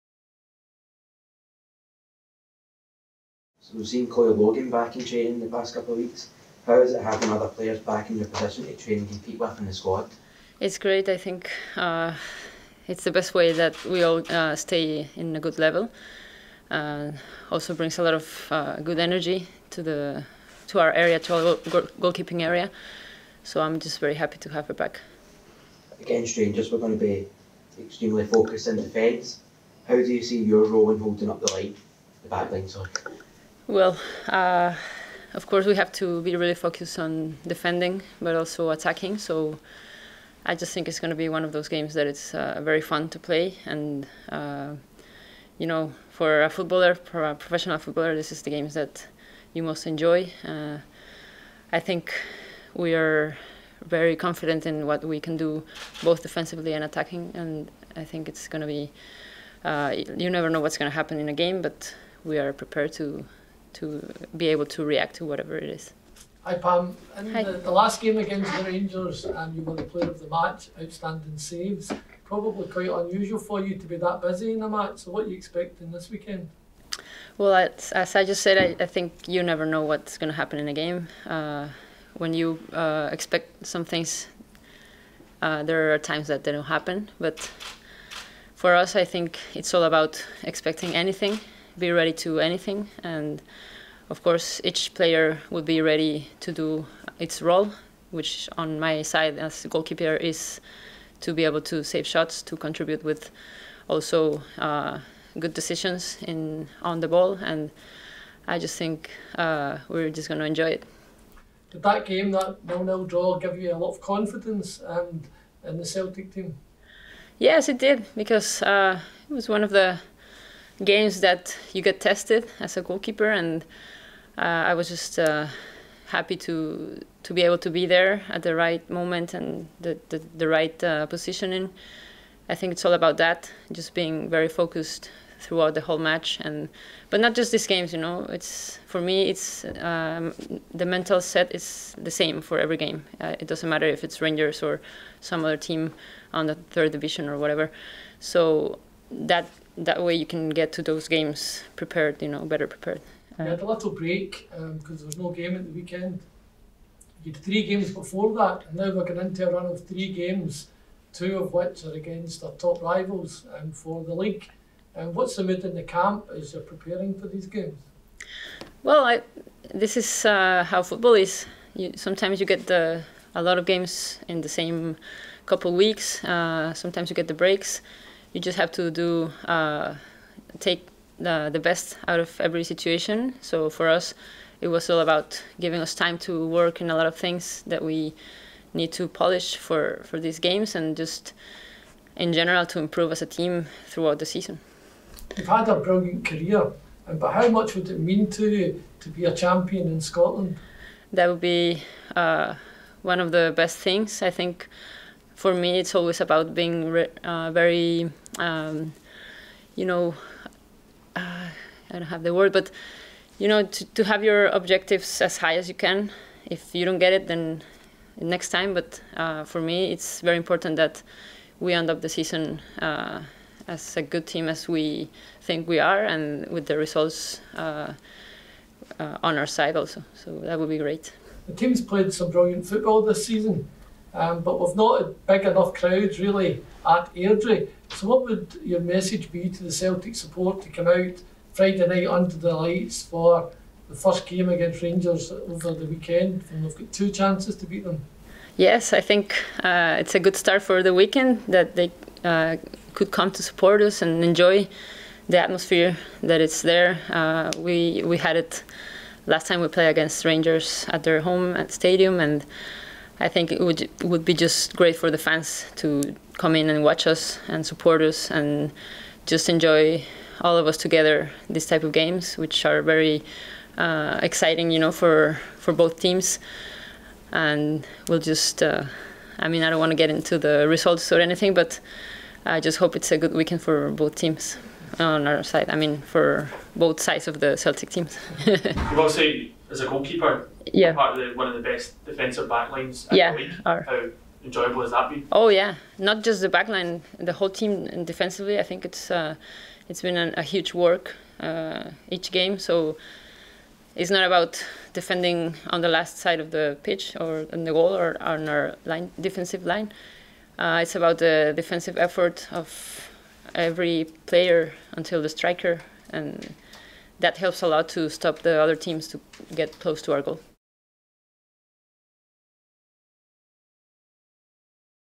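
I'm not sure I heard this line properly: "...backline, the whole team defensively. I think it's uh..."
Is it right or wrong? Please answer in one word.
right.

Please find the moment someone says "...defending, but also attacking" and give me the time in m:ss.
0:37.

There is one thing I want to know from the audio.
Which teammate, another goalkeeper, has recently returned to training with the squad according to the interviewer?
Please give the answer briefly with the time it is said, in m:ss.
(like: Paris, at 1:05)
Chloe Logan, at 0:04.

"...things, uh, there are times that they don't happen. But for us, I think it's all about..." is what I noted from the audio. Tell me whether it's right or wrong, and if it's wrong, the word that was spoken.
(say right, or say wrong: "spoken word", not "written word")
right.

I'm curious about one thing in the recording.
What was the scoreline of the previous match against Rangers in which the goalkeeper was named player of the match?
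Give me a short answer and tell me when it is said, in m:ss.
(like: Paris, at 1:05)
0-0, at 1:52.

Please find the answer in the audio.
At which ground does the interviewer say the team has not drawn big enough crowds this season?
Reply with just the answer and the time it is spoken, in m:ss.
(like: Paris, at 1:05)
Airdrie, at 3:57.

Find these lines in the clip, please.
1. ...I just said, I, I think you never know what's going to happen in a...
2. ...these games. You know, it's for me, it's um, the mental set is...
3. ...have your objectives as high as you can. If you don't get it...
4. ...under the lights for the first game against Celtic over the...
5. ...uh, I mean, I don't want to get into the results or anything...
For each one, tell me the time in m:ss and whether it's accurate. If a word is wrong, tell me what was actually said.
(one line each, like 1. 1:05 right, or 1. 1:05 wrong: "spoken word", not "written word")
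1. 1:18 right
2. 2:17 right
3. 3:34 right
4. 4:02 wrong: "Rangers", not "Celtic"
5. 4:38 right.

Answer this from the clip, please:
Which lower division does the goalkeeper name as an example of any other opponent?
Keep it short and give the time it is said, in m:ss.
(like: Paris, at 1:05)
third division, at 2:26.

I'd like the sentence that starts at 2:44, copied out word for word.
And um, what's the mood in the camp as you're preparing for these games?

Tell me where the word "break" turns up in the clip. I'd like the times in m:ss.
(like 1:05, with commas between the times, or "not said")
2:33, 2:57.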